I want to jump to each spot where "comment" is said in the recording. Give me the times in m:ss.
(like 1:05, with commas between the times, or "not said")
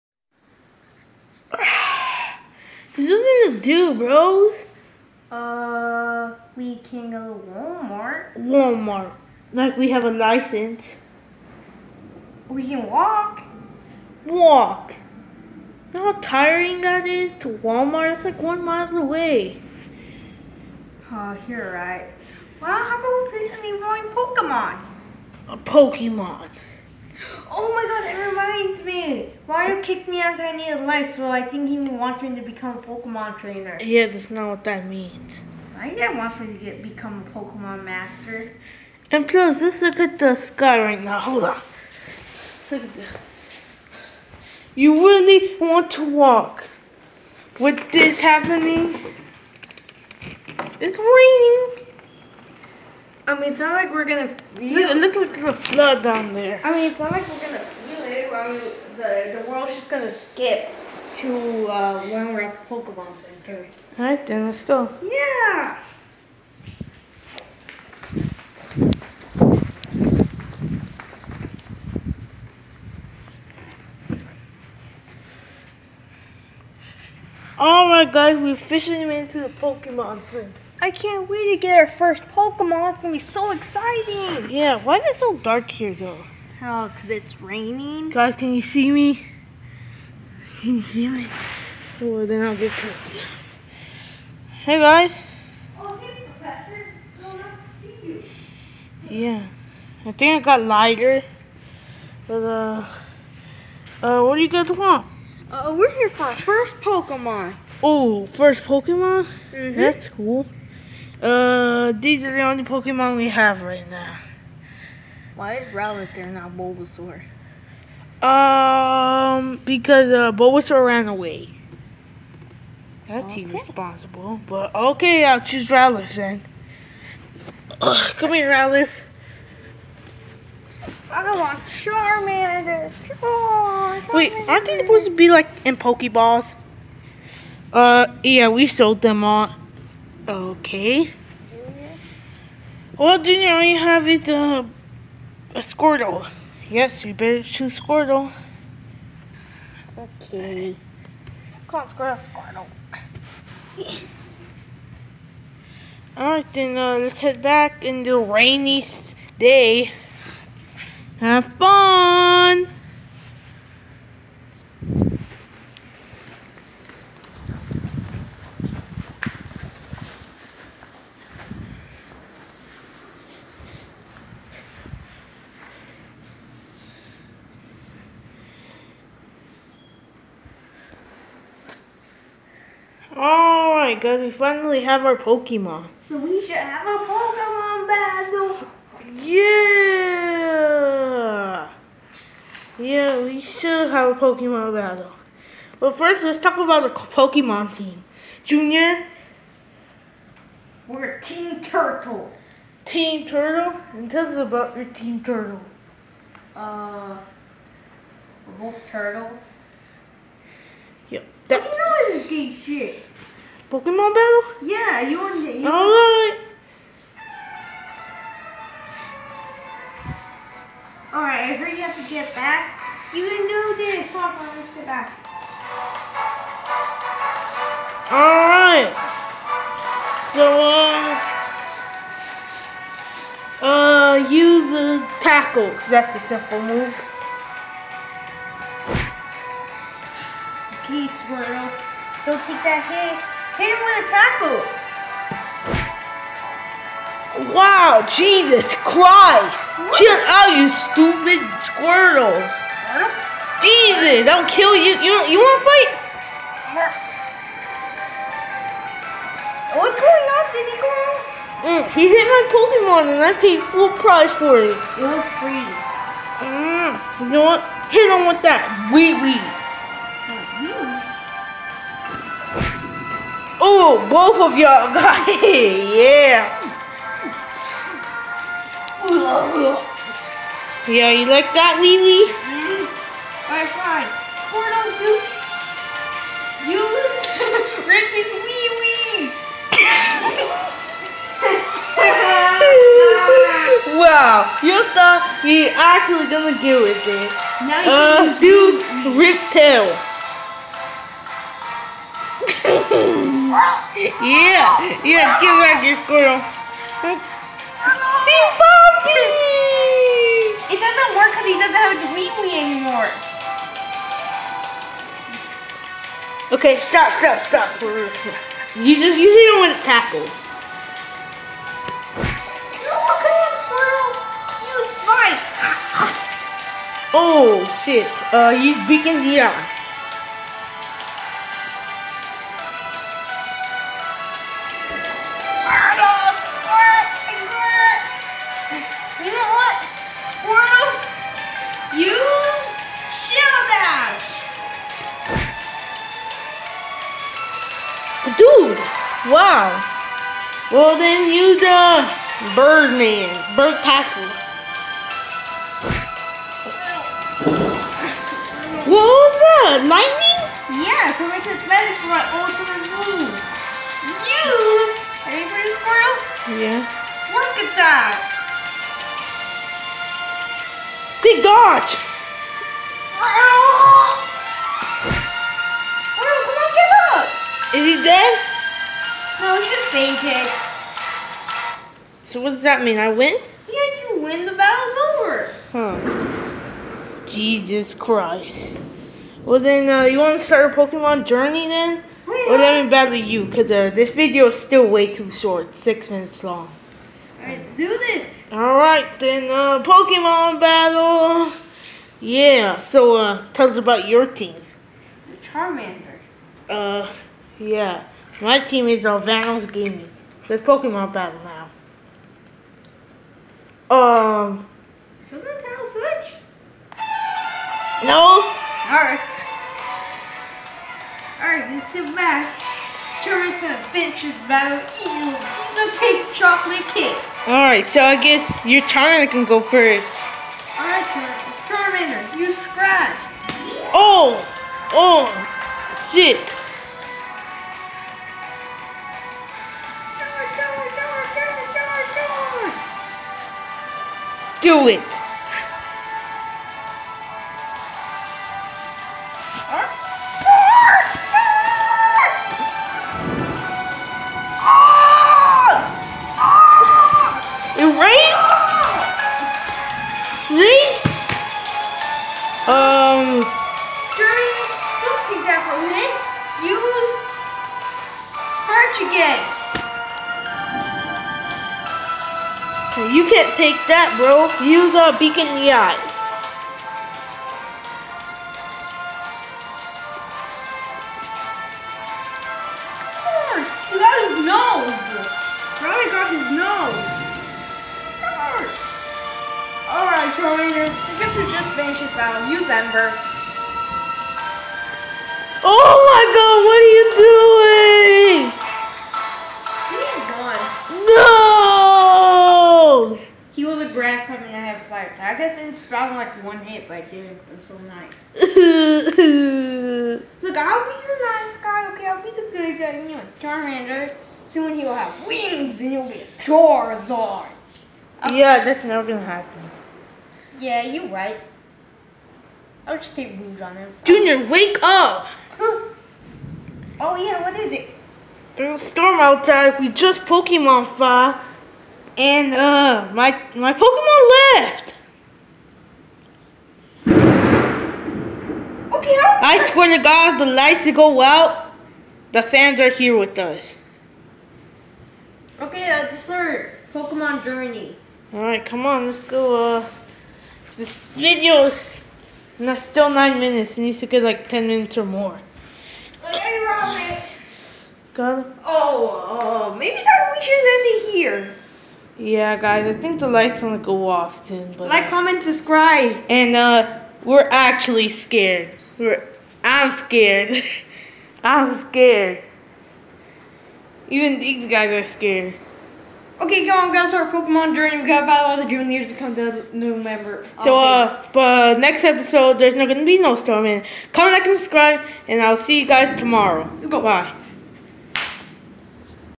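9:25, 9:44.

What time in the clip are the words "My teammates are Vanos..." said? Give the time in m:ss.
6:48.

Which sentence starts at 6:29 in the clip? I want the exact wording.
Well then, uh, you want to start a Pokemon journey then?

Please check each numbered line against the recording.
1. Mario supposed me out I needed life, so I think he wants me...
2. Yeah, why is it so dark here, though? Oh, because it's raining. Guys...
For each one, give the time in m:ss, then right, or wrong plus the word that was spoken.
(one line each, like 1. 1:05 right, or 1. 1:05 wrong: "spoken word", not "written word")
1. 0:29 wrong: "kicked", not "supposed"
2. 1:24 right.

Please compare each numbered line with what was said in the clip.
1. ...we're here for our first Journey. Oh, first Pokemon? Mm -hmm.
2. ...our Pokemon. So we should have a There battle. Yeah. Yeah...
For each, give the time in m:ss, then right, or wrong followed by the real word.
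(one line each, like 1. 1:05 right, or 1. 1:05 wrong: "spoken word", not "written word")
1. 1:45 wrong: "Pokemon", not "Journey"
2. 3:05 wrong: "Pokemon", not "There".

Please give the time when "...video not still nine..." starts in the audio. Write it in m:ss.
9:11.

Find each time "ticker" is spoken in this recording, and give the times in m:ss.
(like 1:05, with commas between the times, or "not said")
not said.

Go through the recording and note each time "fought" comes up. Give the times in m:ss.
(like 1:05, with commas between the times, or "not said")
8:50.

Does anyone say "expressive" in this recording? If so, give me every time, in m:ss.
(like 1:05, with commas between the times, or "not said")
not said.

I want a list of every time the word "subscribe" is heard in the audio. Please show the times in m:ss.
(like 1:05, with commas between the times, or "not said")
9:25, 9:44.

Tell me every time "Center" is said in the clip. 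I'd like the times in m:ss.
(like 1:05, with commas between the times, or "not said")
1:03, 1:20.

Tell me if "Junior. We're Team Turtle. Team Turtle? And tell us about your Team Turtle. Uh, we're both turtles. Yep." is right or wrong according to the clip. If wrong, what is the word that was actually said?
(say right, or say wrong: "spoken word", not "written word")
right.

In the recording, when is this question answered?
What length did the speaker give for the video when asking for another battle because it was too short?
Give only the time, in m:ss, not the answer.
6:35.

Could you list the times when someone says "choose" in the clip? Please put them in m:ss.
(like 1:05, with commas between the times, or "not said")
2:05, 2:27.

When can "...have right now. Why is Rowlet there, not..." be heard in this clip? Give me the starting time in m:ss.
1:53.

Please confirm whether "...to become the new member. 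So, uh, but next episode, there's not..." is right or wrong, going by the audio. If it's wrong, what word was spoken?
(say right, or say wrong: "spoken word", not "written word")
right.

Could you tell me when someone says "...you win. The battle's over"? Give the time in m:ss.
6:24.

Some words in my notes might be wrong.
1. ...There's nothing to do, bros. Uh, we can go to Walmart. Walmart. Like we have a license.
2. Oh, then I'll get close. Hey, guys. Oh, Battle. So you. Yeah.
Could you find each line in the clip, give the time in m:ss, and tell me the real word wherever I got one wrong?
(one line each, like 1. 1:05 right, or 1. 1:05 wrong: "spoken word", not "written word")
1. 0:02 right
2. 1:32 wrong: "Professor", not "Battle".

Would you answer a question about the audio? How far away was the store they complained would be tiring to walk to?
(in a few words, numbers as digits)
One mile.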